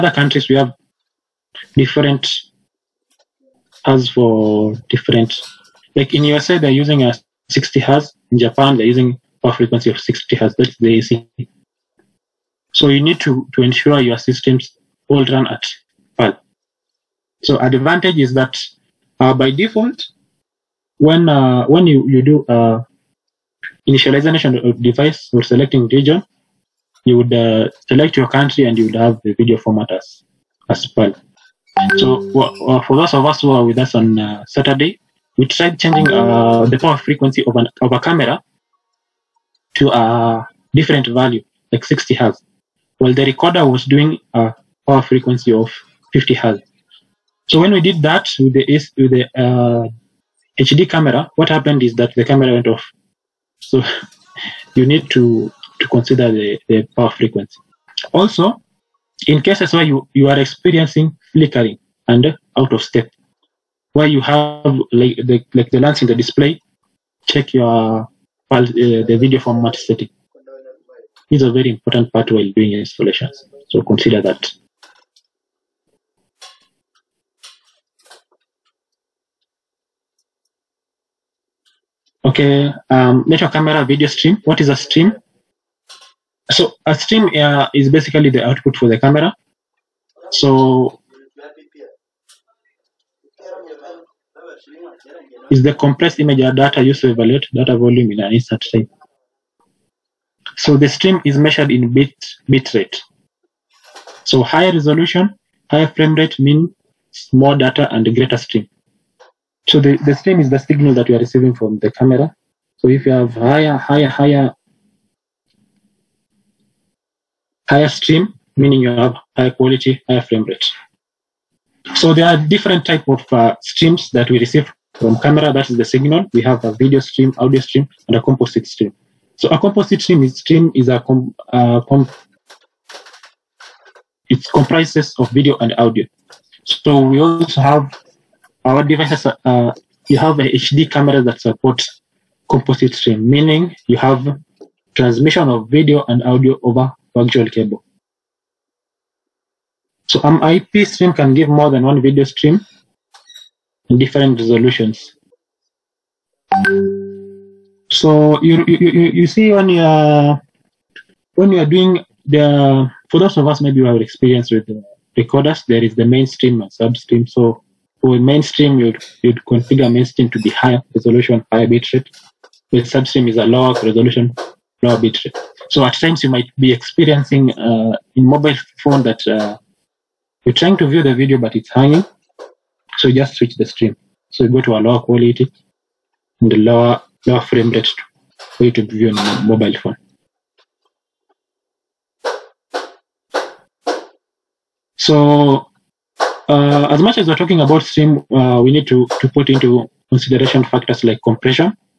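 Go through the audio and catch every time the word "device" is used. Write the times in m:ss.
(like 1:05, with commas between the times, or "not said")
0:24, 2:18.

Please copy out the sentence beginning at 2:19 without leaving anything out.
Uh, you have a HD camera that supports composite stream, meaning you have transmission of video and audio over virtual cable.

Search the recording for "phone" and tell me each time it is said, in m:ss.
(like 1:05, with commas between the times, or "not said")
2:58, 3:09.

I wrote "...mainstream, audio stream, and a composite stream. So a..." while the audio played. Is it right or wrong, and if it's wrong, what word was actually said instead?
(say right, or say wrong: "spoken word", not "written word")
wrong: "stream", not "mainstream".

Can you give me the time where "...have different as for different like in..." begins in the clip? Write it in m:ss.
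0:00.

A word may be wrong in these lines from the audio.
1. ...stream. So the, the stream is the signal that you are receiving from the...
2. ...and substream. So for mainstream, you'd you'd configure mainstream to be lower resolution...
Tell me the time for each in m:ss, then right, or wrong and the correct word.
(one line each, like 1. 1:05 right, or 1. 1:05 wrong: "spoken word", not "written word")
1. 1:48 right
2. 2:46 wrong: "higher", not "lower".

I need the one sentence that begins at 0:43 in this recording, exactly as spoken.
Well, the recorder was doing a power frequency of 50 hertz.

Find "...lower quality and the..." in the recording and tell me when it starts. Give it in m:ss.
3:04.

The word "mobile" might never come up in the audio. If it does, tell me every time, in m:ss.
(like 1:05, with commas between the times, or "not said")
2:58, 3:09.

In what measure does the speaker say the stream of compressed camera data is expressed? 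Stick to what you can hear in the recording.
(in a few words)
Bit rate.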